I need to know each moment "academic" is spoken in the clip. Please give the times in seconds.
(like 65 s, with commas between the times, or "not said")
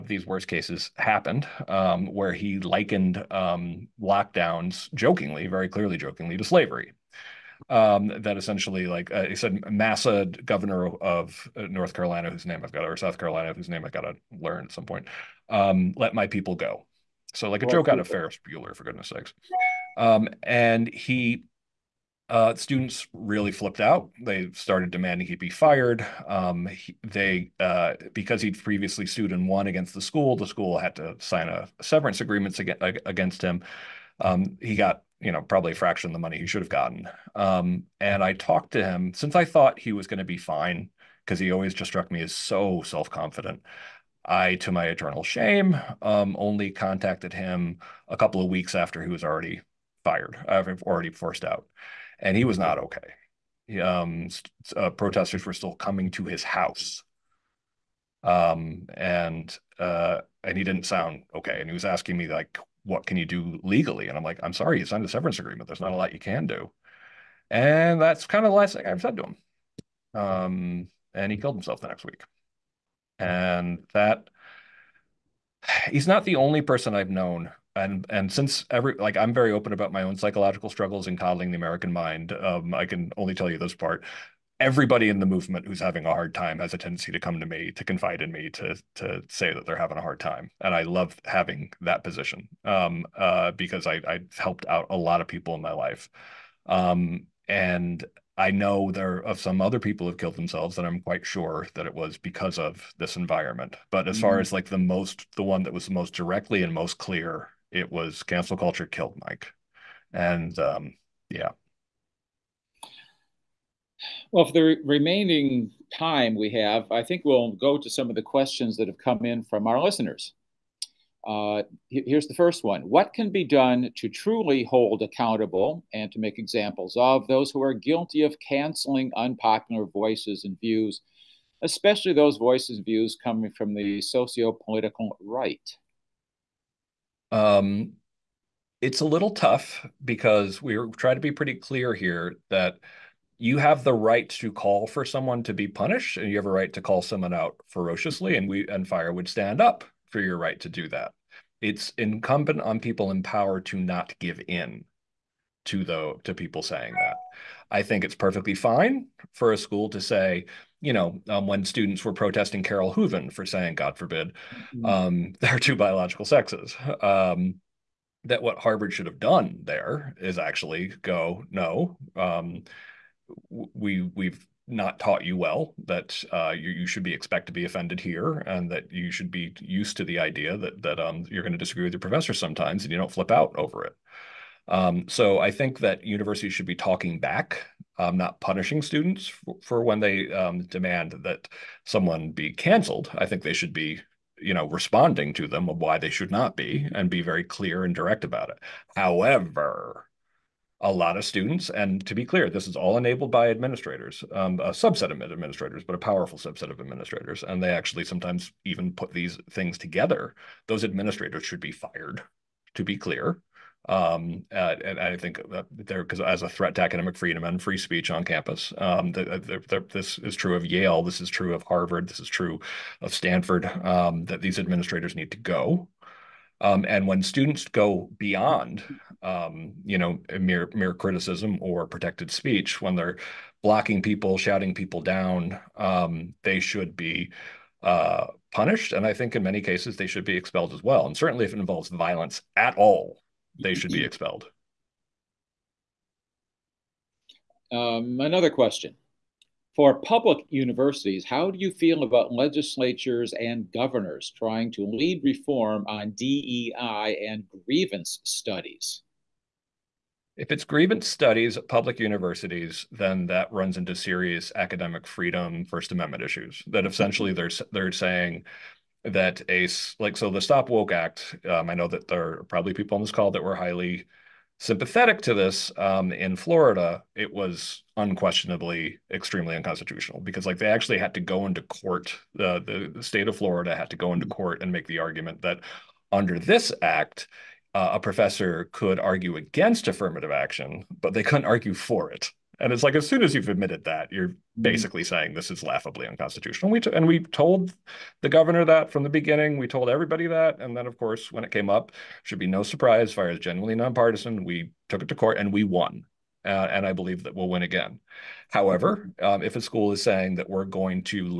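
216 s, 264 s.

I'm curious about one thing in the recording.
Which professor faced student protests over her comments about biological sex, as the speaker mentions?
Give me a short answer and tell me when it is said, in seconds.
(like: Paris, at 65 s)
Carole Hooven, at 162 s.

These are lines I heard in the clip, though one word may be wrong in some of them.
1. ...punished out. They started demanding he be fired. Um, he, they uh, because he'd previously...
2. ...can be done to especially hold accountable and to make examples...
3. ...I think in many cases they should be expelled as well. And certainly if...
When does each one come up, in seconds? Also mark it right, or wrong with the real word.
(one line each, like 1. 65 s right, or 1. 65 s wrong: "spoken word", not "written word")
1. 23 s wrong: "flipped", not "punished"
2. 123 s wrong: "truly", not "especially"
3. 239 s right.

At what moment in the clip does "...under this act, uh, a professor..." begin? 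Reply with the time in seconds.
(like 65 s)
286 s.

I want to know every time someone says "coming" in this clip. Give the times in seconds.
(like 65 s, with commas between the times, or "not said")
55 s, 133 s.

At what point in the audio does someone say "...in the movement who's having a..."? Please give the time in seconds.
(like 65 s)
85 s.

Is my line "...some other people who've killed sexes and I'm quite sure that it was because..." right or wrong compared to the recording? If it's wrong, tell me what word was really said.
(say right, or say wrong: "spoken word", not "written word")
wrong: "themselves", not "sexes".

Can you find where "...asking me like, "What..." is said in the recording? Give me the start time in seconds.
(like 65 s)
61 s.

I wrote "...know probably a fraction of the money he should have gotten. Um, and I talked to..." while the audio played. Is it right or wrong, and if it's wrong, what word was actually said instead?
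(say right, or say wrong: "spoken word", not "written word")
right.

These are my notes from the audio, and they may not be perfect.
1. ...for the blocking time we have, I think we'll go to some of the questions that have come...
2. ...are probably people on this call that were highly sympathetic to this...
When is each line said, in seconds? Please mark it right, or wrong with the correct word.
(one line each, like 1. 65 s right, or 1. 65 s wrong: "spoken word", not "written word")
1. 114 s wrong: "remaining", not "blocking"
2. 272 s right.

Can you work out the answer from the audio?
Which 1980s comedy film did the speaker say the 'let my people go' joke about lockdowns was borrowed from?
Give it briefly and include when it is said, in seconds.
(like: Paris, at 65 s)
Ferris Bueller, at 18 s.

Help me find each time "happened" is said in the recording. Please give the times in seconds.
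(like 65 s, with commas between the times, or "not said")
0 s.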